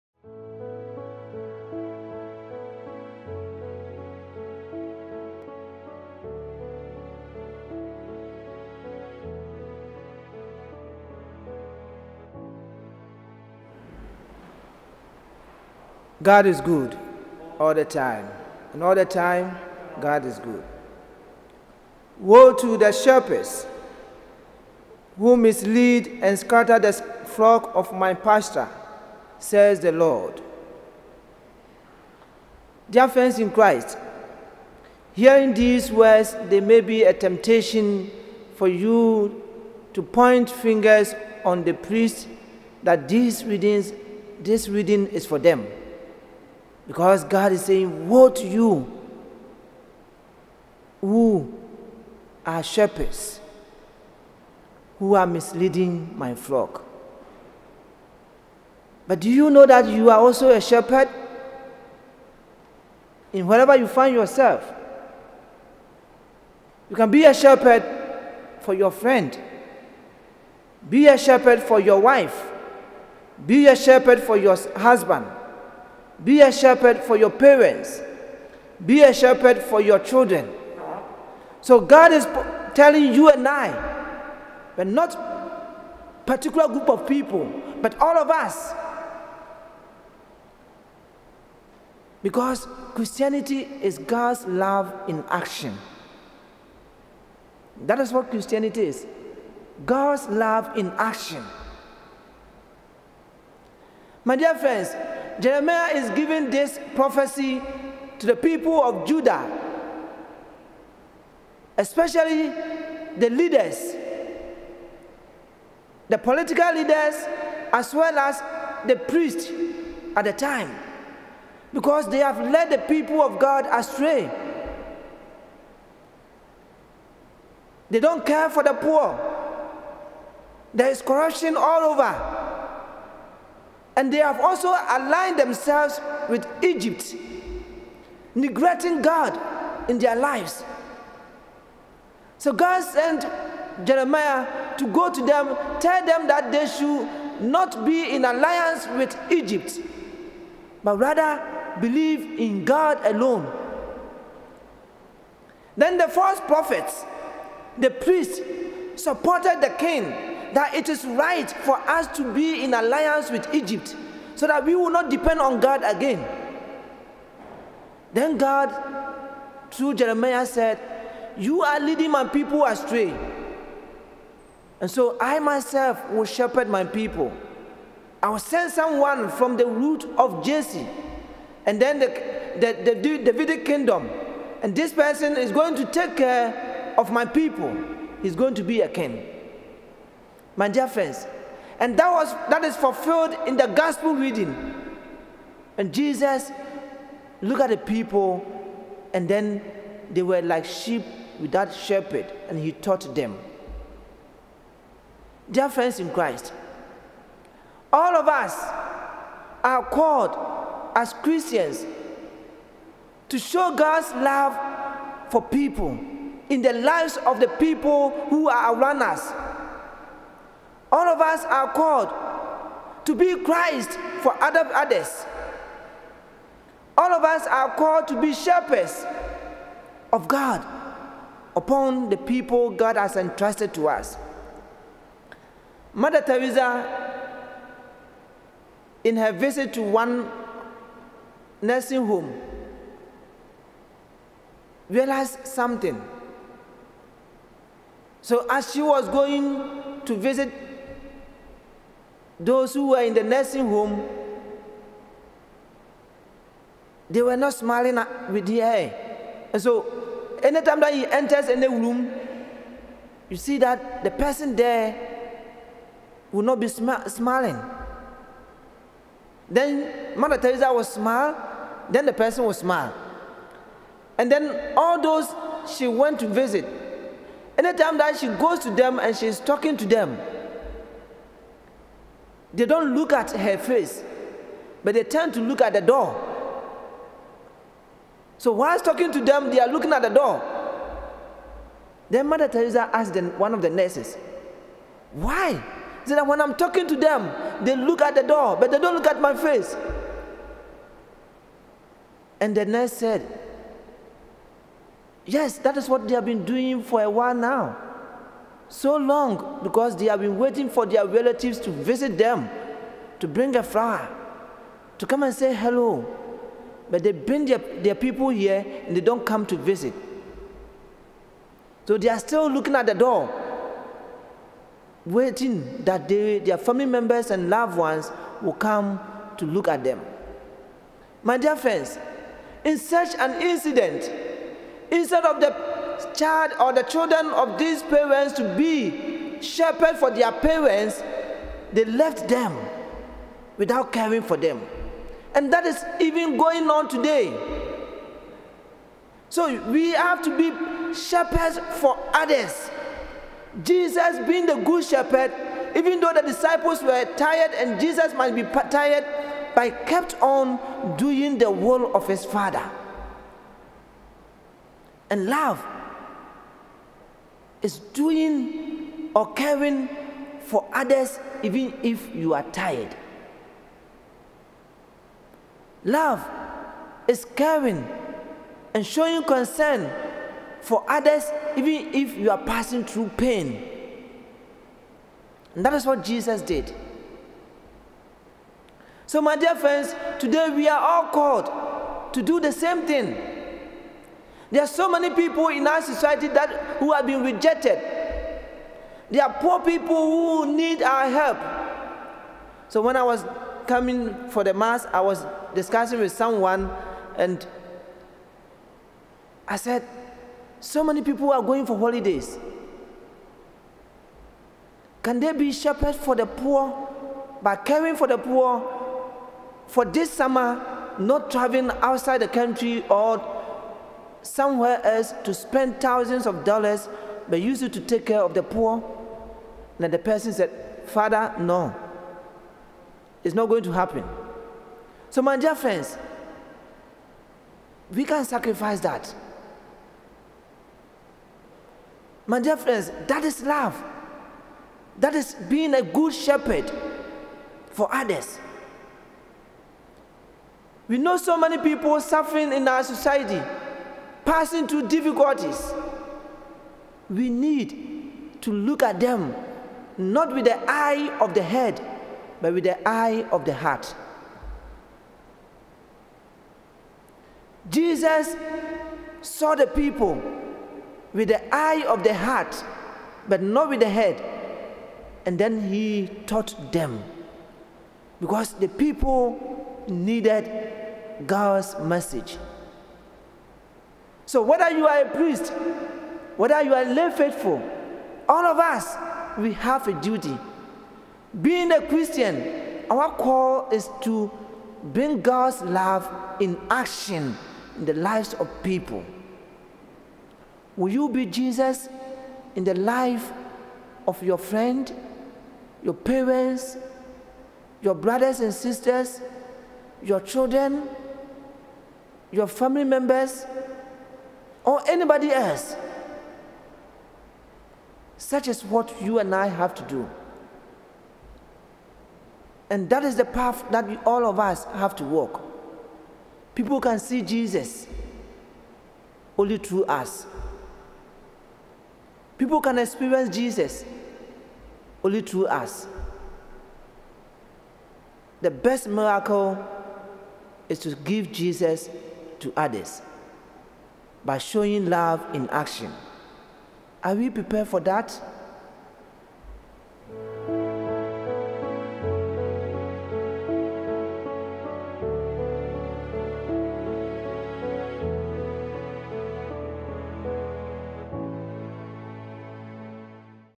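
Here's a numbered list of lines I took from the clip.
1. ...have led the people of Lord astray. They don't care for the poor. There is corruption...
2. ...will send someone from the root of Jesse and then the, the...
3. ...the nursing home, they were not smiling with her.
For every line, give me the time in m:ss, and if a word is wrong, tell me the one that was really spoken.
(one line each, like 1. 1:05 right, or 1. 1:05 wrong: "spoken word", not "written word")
1. 2:02 wrong: "God", not "Lord"
2. 2:58 right
3. 4:13 right.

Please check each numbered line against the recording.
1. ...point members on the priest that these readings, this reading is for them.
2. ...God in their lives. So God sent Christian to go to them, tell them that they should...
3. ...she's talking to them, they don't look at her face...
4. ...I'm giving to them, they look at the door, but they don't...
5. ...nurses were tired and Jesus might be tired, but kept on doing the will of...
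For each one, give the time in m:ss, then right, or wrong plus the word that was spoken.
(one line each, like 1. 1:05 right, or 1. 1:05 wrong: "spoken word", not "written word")
1. 0:40 wrong: "fingers", not "members"
2. 2:19 wrong: "Jeremiah", not "Christian"
3. 4:39 right
4. 4:56 wrong: "talking", not "giving"
5. 5:56 wrong: "disciples", not "nurses".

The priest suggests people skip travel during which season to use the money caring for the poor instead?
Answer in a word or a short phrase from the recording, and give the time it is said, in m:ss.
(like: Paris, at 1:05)
summer, at 7:00.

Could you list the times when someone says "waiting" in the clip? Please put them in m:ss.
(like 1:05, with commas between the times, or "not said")
5:10, 5:25.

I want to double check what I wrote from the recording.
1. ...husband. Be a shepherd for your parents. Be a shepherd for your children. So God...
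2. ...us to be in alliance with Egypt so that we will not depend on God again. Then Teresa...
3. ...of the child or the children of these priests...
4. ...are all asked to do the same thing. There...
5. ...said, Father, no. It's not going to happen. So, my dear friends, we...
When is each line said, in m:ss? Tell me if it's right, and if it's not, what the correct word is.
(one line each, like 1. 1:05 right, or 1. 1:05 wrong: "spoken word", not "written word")
1. 1:14 right
2. 2:41 wrong: "God", not "Teresa"
3. 5:35 wrong: "parents", not "priests"
4. 6:30 wrong: "called", not "asked"
5. 7:10 right.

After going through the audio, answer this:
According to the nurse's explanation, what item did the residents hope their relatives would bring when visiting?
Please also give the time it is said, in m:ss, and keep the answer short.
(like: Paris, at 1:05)
a flower, at 5:13.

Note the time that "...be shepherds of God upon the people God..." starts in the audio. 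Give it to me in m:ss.
3:48.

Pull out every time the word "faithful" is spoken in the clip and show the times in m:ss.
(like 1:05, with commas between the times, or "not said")
8:07.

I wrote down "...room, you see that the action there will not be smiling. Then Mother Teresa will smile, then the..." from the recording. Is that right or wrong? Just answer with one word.
wrong.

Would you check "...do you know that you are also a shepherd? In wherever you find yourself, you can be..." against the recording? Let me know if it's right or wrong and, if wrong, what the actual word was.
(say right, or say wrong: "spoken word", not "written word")
right.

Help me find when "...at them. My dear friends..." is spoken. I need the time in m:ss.
5:29.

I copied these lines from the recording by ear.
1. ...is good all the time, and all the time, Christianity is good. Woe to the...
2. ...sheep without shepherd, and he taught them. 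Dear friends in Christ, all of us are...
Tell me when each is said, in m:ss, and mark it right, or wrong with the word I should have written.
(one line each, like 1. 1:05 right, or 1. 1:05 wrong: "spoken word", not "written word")
1. 0:16 wrong: "God", not "Christianity"
2. 3:20 right.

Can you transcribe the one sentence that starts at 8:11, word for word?
Being a Christian, our call is to bring God's love in action in the lives of people.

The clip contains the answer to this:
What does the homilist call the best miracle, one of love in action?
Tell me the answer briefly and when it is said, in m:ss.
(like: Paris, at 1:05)
give Jesus to others, at 9:00.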